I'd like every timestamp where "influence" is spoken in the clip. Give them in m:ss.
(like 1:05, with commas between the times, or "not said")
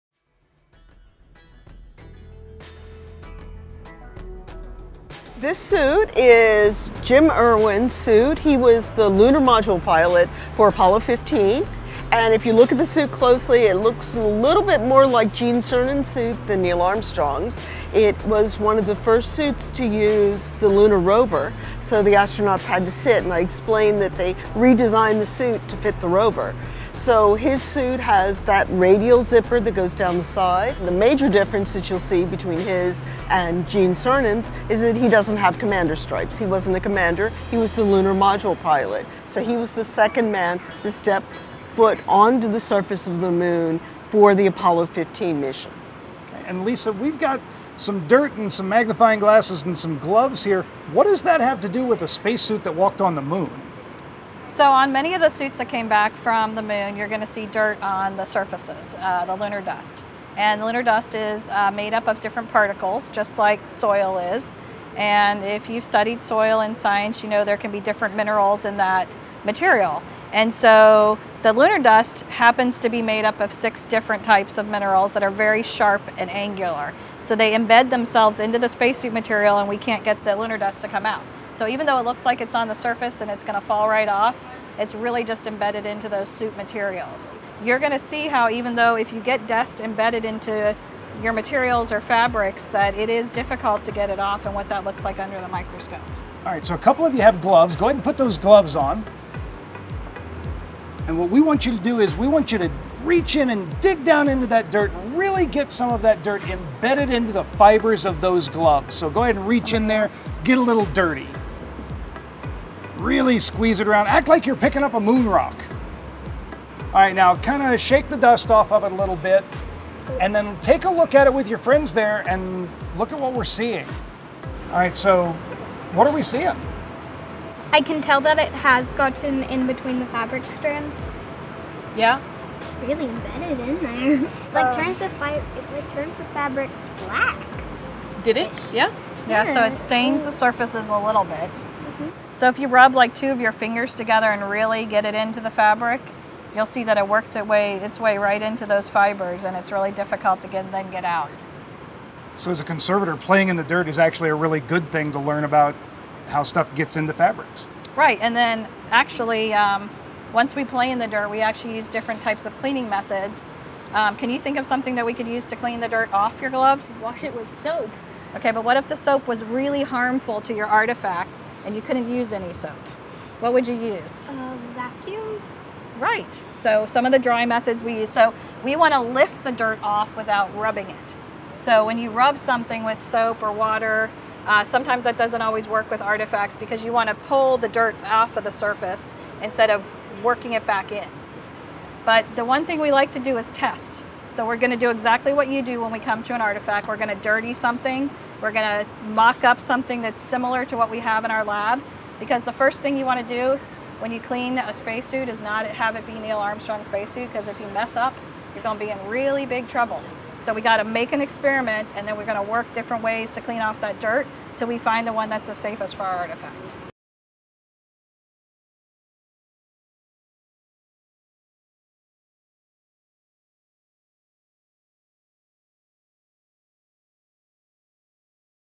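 not said.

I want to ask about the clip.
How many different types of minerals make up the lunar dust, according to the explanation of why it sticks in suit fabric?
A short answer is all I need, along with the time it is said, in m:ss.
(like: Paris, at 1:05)
6, at 1:13.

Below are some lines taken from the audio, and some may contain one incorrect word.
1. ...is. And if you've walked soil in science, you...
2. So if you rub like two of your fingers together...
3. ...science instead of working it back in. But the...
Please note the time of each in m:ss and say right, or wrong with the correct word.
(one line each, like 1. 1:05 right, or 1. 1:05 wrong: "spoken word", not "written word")
1. 1:04 wrong: "studied", not "walked"
2. 2:22 right
3. 3:08 wrong: "surface", not "science".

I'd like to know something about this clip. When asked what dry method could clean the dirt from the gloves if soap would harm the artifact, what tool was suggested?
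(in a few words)
A vacuum.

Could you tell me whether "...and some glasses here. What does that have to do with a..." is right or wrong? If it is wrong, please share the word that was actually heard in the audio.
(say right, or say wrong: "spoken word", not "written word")
wrong: "gloves", not "glasses".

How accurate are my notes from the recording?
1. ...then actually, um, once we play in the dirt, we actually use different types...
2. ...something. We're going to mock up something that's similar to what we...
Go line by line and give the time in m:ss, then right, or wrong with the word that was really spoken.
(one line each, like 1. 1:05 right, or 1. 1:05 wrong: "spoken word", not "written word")
1. 2:38 right
2. 3:17 right.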